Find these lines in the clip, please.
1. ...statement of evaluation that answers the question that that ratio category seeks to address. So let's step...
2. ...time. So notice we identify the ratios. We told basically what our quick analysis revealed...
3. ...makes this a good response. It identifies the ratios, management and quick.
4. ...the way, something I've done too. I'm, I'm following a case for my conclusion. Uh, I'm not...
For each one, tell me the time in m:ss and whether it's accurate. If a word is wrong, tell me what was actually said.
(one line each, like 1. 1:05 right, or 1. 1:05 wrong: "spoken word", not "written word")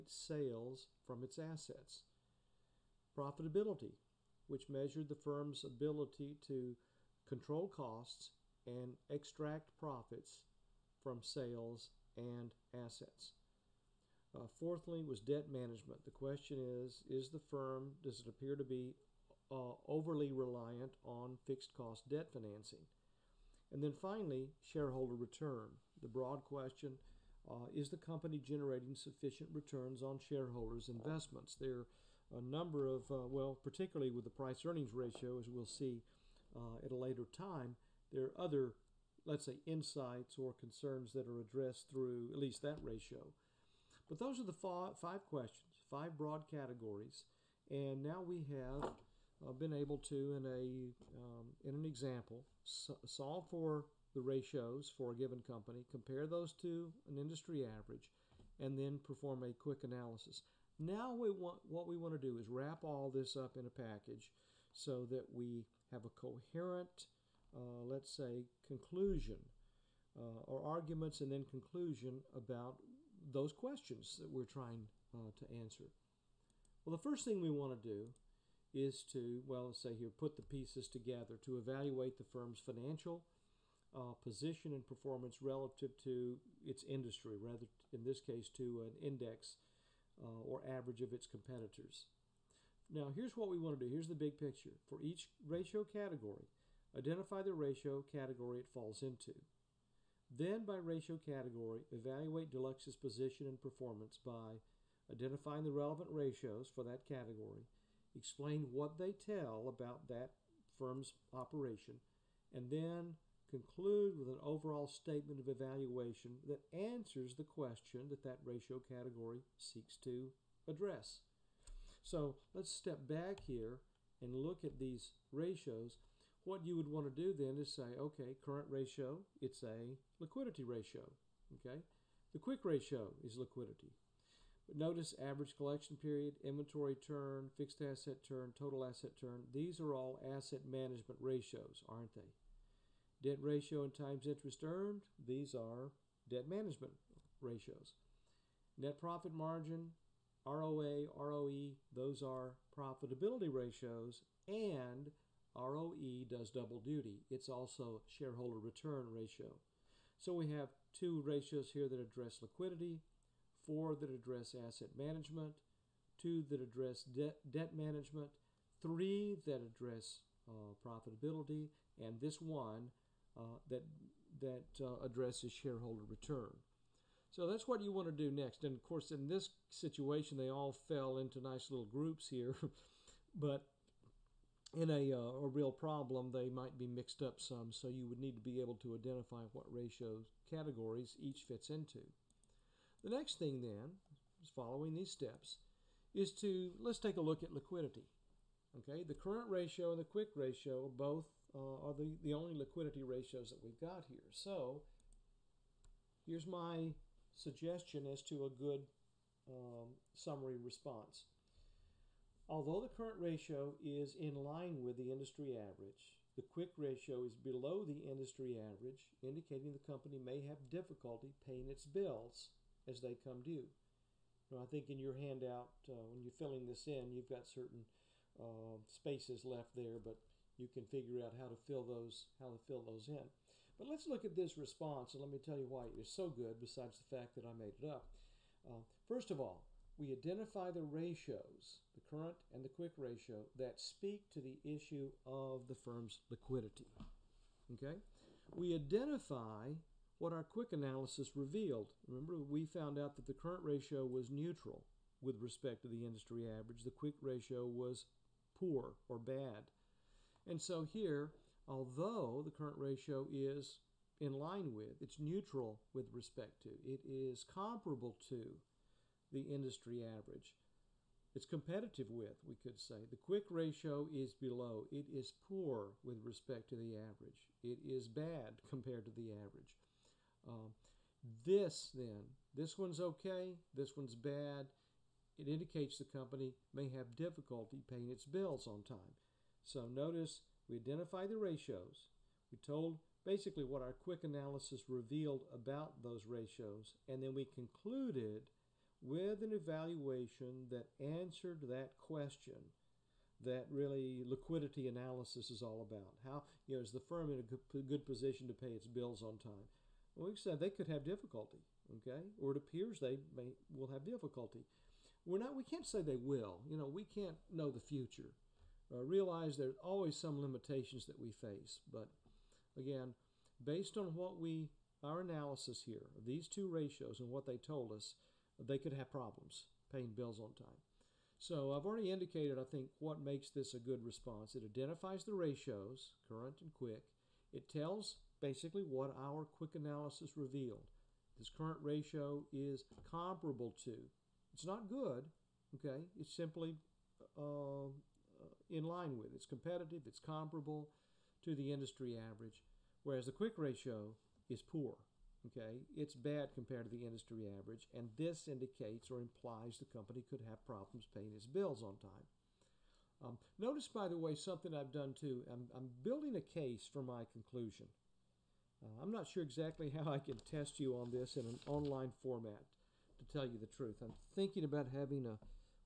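1. 1:54 right
2. 4:48 right
3. 5:33 wrong: "current", not "management"
4. 6:04 wrong: "building", not "following".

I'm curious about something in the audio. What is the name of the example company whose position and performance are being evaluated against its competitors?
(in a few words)
Delux.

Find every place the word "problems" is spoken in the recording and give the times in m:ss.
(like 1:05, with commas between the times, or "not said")
3:05, 5:29, 6:00.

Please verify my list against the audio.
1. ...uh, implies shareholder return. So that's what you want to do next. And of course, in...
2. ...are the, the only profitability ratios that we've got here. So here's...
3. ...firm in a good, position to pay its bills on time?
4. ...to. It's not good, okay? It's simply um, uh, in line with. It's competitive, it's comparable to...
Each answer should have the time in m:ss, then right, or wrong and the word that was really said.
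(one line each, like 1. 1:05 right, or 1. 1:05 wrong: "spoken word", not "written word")
1. 2:54 wrong: "addresses", not "implies"
2. 3:21 wrong: "liquidity", not "profitability"
3. 5:07 right
4. 5:43 right.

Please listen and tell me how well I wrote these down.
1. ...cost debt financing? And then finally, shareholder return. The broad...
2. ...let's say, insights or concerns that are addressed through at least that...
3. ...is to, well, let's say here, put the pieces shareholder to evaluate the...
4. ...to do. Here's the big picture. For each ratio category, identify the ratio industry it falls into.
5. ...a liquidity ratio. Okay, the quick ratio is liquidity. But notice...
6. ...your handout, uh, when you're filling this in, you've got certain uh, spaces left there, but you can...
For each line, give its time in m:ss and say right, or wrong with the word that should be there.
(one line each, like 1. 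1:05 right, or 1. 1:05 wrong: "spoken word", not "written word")
1. 0:21 right
2. 0:39 right
3. 1:18 wrong: "together", not "shareholder"
4. 1:33 wrong: "category", not "industry"
5. 2:09 right
6. 3:44 right.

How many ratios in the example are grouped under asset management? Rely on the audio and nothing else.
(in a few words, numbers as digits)
4.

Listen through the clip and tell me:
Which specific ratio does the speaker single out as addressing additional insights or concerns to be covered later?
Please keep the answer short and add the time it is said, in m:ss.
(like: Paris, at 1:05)
price earnings ratio, at 0:34.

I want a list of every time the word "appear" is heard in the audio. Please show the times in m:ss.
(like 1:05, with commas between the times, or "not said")
0:18, 5:12.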